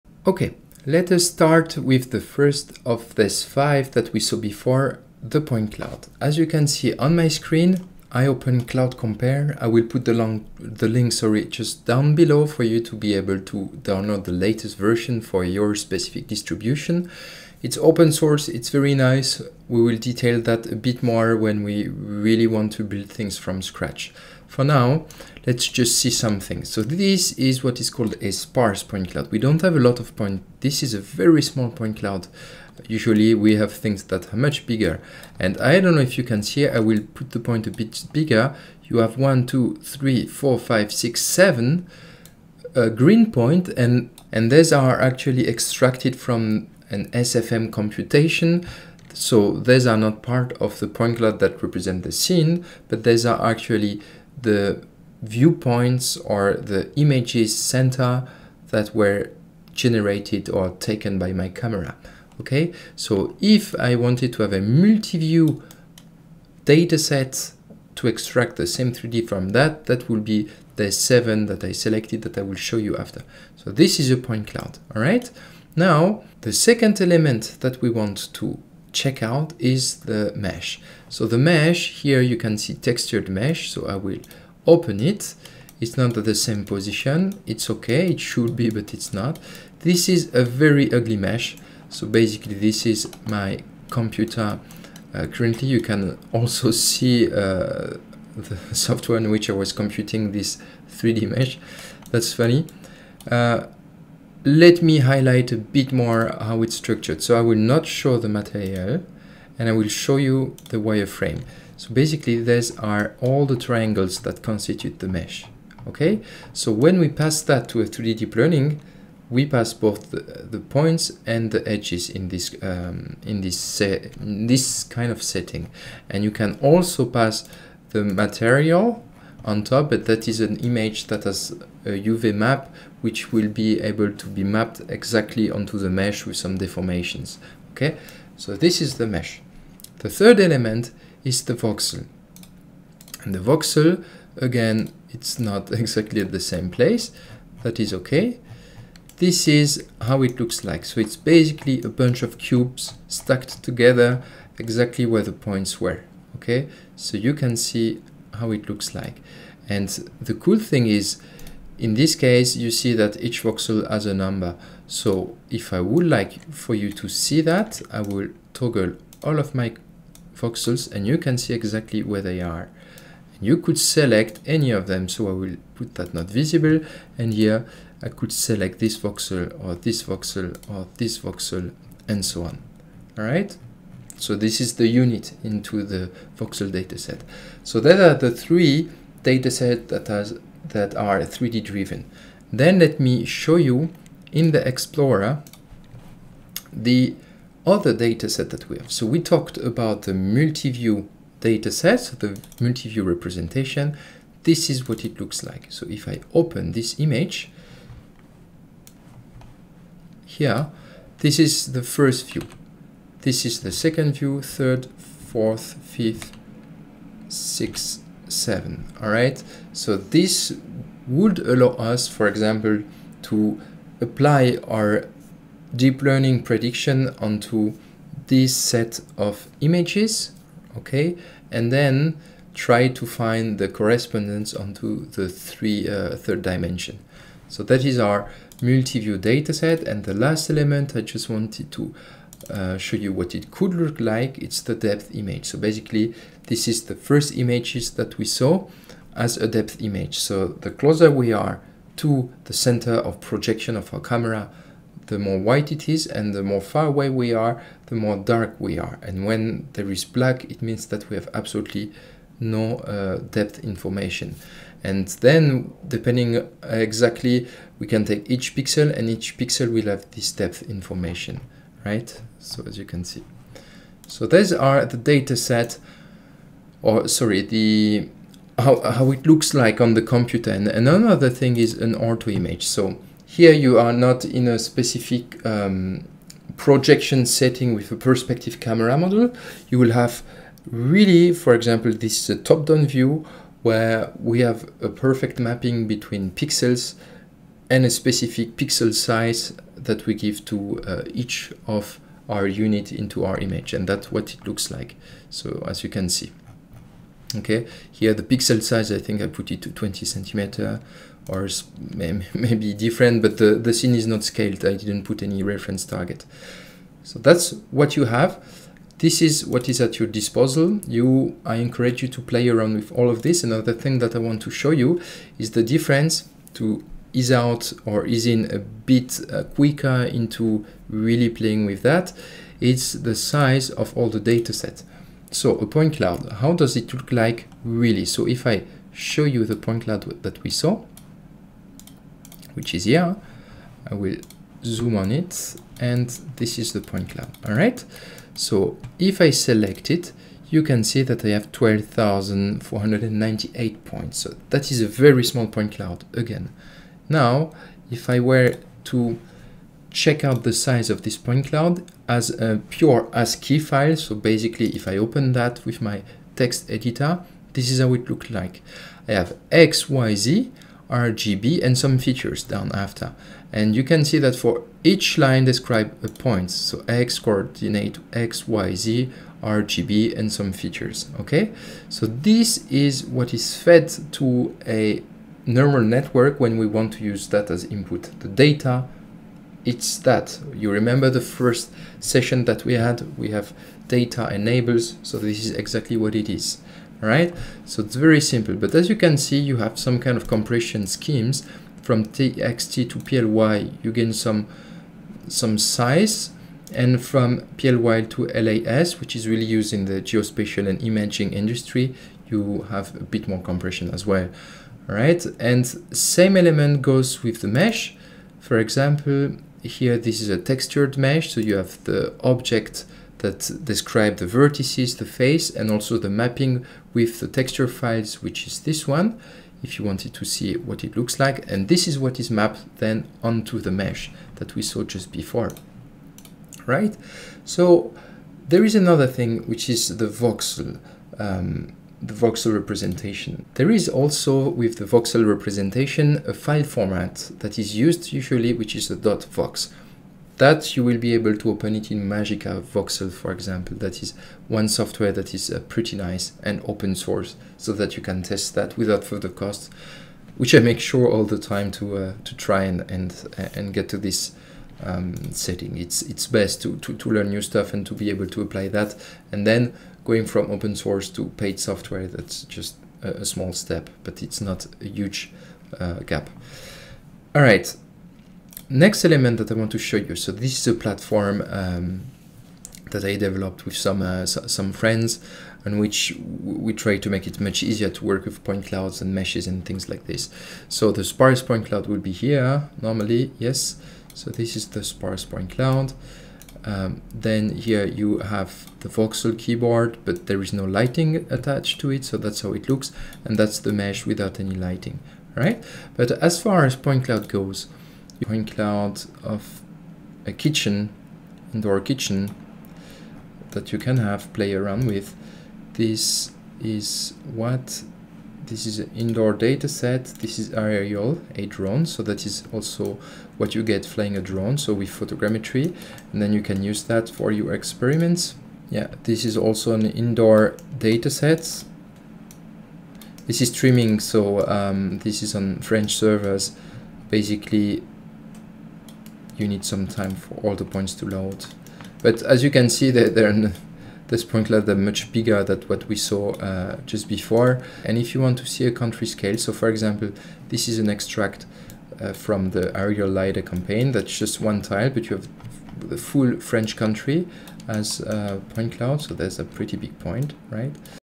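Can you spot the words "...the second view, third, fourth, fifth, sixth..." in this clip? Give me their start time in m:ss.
3:33.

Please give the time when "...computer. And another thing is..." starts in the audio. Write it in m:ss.
4:40.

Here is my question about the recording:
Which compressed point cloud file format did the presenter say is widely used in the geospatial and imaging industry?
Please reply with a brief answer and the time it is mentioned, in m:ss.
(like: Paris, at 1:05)
LAS, at 6:48.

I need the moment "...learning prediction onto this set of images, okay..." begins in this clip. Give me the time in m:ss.
3:46.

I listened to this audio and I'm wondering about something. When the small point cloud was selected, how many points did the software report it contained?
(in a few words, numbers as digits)
12,498.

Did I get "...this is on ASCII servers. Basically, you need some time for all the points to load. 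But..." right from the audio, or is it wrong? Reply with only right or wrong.
wrong.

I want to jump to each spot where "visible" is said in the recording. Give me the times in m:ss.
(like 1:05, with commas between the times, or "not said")
2:56.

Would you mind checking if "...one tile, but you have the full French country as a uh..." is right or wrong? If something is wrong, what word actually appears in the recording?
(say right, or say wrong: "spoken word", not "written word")
right.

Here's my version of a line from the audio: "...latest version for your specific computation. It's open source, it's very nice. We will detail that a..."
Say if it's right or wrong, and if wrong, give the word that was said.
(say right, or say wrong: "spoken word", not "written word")
wrong: "distribution", not "computation".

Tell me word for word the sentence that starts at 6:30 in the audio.
You remember the first session that we had?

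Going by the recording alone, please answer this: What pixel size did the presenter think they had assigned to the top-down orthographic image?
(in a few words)
20 centimeters.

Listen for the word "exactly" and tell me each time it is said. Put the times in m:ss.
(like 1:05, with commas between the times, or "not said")
2:14, 2:25, 2:34, 2:51, 4:26, 6:35.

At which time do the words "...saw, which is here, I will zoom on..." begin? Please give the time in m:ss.
5:40.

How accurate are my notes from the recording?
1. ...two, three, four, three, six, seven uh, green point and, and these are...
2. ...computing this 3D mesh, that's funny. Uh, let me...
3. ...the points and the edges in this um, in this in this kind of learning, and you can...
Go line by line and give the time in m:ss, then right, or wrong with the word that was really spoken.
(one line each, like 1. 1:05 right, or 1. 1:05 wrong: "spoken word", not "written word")
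1. 0:39 wrong: "five", not "three"
2. 1:39 right
3. 2:00 wrong: "setting", not "learning".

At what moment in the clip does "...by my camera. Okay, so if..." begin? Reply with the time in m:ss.
1:01.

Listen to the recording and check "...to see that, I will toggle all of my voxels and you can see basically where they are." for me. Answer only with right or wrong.
wrong.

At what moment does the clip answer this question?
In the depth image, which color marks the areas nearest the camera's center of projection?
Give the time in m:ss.
4:15.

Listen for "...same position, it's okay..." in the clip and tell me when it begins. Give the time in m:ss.
1:26.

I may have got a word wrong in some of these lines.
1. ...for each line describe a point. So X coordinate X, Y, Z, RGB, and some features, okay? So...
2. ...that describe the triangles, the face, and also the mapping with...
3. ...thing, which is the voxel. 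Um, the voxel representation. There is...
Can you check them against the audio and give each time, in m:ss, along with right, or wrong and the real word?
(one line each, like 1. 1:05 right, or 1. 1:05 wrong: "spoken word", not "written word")
1. 6:14 right
2. 7:03 wrong: "vertices", not "triangles"
3. 7:19 right.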